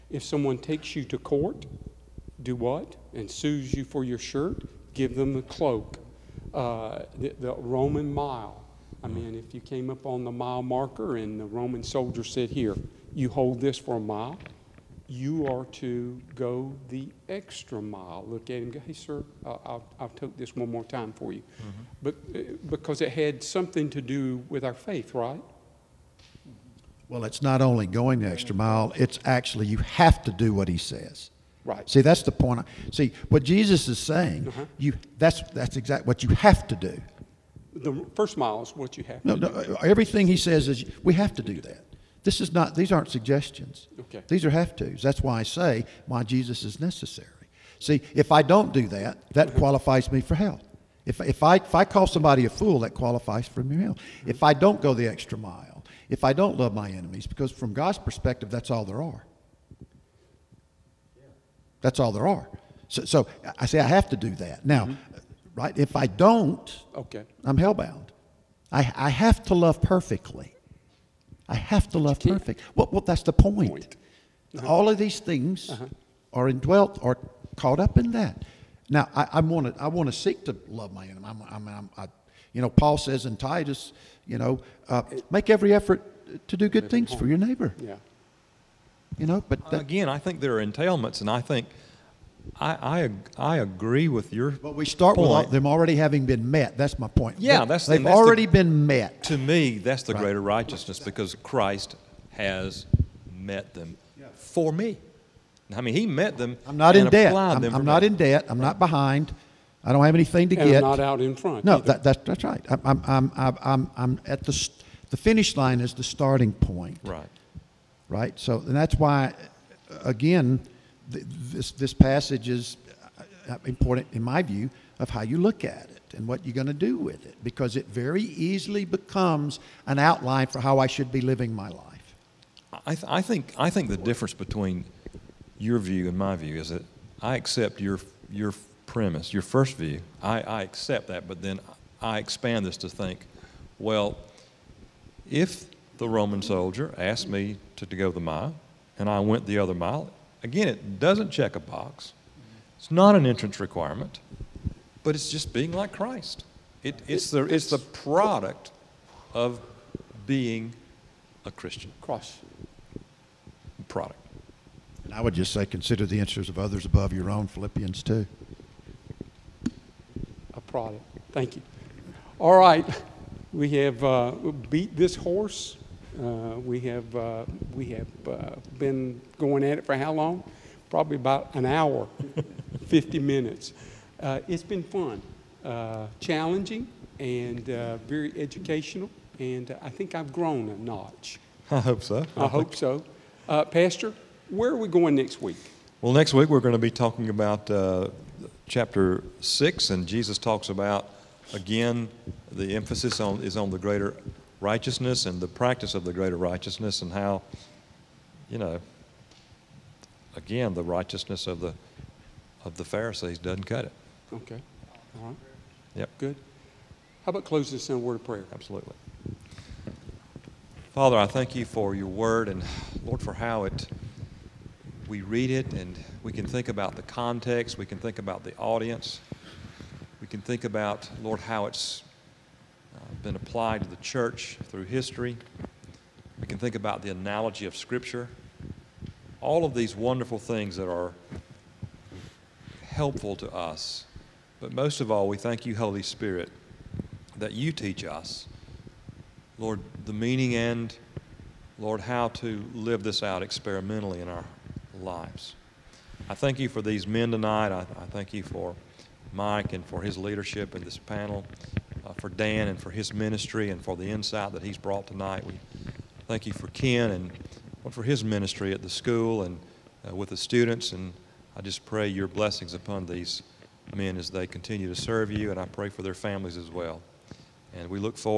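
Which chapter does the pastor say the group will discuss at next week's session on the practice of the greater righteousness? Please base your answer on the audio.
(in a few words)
Chapter 6.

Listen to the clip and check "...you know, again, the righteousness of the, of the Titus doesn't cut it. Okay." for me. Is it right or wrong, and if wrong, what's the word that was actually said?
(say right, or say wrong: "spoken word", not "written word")
wrong: "Pharisees", not "Titus".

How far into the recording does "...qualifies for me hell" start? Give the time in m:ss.
0:52.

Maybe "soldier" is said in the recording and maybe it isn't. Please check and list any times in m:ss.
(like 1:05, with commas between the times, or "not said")
0:11, 2:26.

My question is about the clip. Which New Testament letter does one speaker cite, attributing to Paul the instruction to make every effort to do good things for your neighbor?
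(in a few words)
Titus.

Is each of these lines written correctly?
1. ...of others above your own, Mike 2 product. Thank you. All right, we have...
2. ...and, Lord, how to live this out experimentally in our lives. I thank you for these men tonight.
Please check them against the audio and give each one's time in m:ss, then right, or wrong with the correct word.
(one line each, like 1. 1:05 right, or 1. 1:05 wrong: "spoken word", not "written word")
1. 2:46 wrong: "Philippians", not "Mike"
2. 4:10 right.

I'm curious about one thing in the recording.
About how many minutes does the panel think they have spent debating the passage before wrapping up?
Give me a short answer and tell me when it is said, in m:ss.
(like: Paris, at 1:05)
50, at 3:02.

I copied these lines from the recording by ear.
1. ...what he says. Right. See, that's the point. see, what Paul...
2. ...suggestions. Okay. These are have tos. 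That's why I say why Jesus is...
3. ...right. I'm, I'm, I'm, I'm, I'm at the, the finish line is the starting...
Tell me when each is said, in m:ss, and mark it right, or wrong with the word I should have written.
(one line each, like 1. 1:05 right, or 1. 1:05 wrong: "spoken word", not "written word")
1. 0:30 wrong: "Jesus", not "Paul"
2. 0:43 right
3. 1:52 right.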